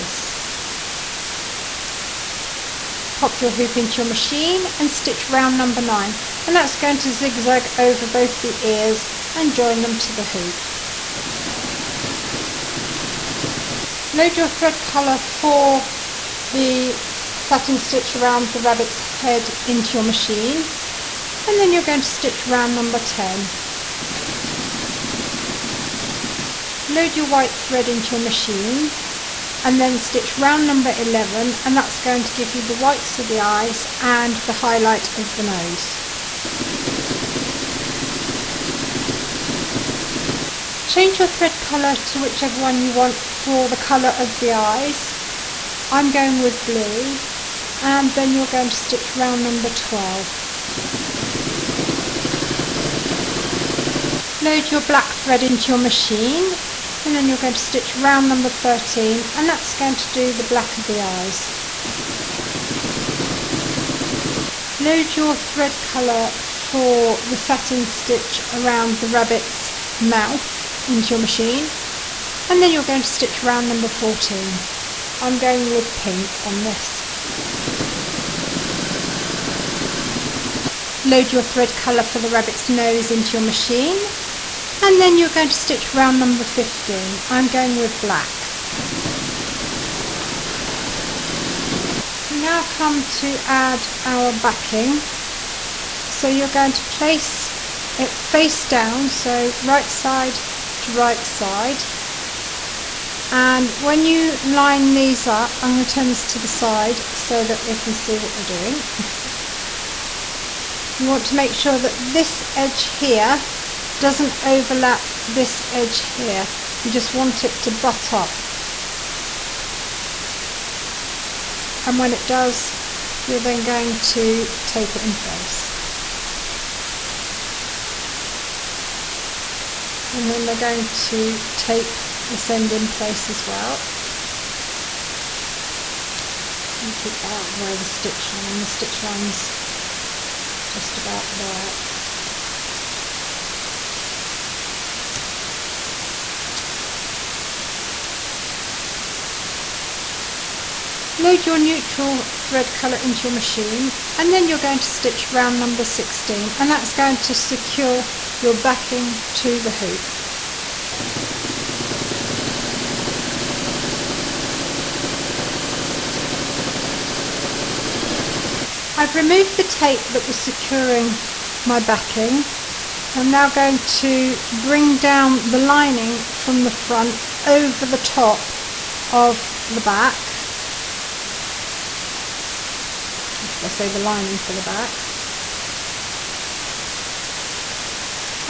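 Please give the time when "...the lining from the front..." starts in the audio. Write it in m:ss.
2:55.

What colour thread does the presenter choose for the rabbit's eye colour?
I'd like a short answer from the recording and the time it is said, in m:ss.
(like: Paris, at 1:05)
Blue, at 0:46.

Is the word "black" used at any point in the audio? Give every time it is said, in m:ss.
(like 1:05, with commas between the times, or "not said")
0:54, 1:00, 1:28.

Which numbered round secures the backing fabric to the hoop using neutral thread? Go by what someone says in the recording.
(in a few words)
16.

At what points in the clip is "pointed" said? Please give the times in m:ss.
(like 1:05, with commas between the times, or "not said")
not said.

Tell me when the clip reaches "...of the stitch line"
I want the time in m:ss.
2:17.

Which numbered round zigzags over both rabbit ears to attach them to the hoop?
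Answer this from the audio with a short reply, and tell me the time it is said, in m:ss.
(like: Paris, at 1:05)
9, at 0:05.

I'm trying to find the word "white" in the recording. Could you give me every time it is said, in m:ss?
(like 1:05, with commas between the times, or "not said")
0:27, 0:32.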